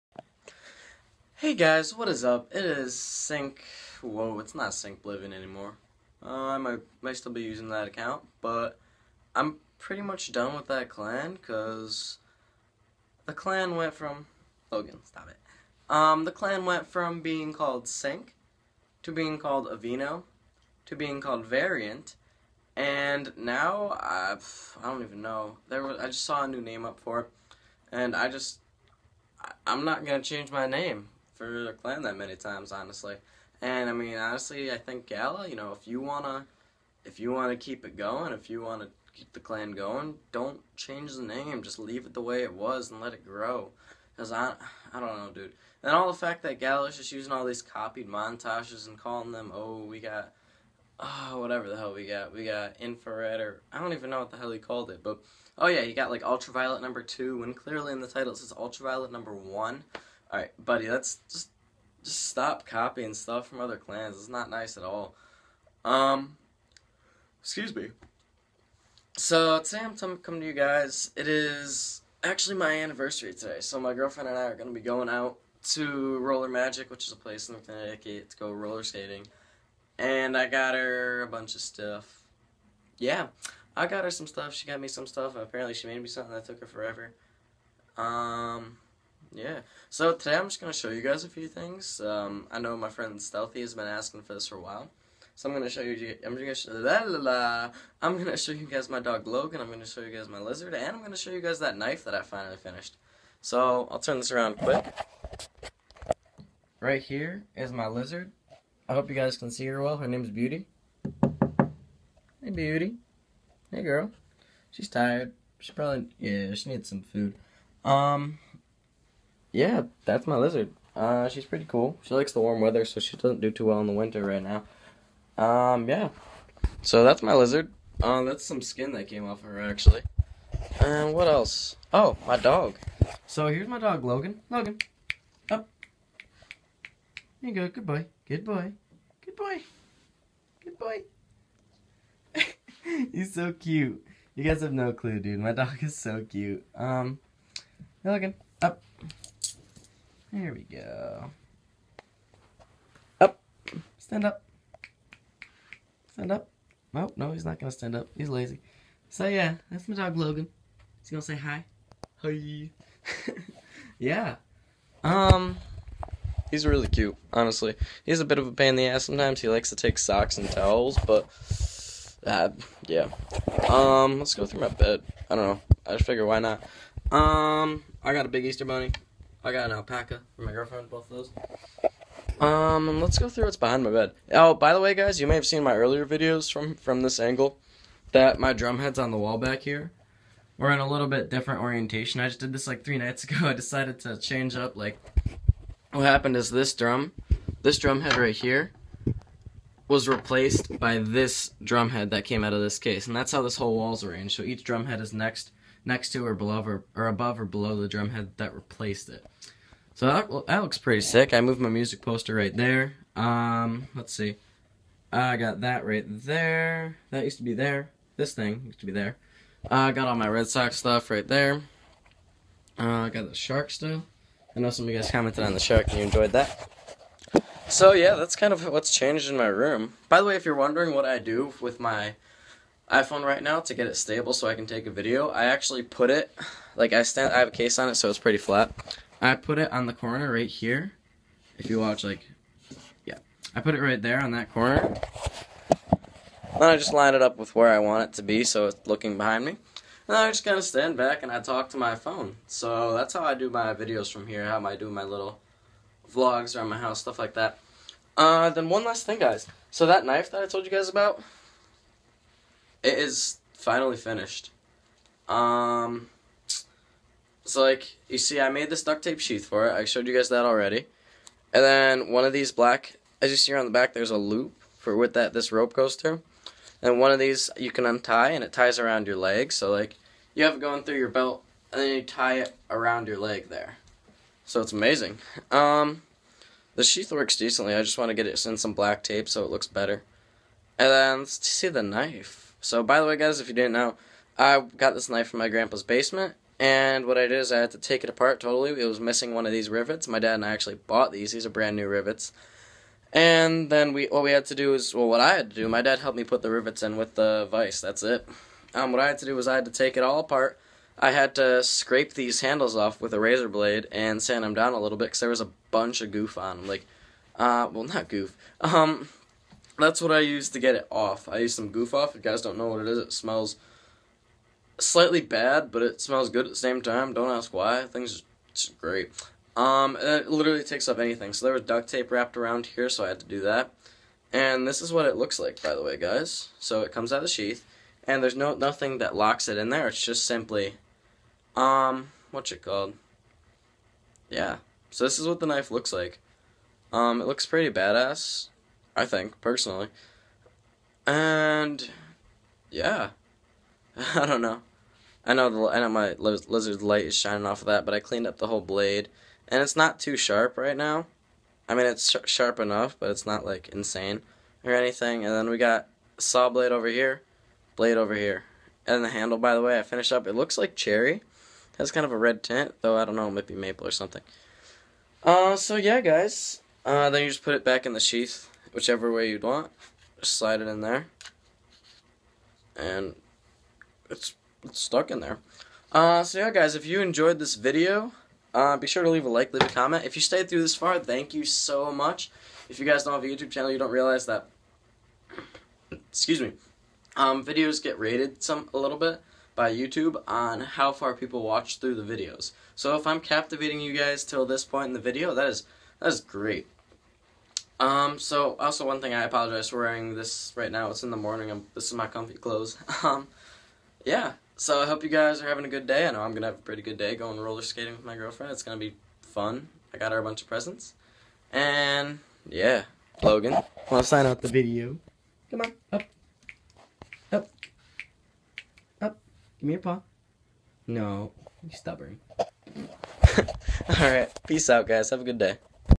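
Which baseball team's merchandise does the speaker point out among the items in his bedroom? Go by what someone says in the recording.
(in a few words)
Red Sox.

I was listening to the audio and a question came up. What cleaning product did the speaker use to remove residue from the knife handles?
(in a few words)
Goof Off.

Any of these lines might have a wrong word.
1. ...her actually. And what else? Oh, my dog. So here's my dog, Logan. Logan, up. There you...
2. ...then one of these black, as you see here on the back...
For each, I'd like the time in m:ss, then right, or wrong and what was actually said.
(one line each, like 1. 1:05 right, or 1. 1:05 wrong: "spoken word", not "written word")
1. 2:09 right
2. 4:31 right.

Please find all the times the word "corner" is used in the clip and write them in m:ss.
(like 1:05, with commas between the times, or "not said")
3:59, 4:04.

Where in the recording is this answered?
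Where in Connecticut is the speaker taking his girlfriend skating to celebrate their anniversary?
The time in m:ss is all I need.
1:16.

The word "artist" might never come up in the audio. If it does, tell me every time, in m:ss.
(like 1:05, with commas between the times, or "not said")
not said.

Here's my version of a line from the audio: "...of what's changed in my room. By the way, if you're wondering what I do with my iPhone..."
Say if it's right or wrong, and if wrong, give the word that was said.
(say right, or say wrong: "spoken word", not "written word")
right.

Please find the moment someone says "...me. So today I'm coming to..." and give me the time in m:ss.
1:07.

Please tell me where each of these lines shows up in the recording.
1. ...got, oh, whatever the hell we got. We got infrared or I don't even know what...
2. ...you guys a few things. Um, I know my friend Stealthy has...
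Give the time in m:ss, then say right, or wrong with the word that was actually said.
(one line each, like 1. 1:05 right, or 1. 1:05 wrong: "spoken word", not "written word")
1. 0:49 right
2. 1:30 right.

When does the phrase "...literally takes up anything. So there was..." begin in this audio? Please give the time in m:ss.
5:30.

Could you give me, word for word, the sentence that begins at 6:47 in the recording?
Um, so also one thing I apologize for wearing this right now.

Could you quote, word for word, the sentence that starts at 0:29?
I, I'm not going to change my name for the clan that many times, honestly.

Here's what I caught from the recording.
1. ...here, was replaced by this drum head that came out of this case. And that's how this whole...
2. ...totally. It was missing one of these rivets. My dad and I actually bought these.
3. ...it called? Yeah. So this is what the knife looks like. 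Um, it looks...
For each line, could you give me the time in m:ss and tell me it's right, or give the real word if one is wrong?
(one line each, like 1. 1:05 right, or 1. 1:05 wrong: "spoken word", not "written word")
1. 3:18 right
2. 4:58 right
3. 5:42 right.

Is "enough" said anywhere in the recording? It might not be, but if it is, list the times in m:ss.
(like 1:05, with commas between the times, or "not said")
6:02.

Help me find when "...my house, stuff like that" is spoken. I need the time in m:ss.
4:16.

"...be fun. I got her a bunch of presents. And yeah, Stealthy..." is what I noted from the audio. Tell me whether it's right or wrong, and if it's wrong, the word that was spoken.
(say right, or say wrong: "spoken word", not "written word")
wrong: "Logan", not "Stealthy".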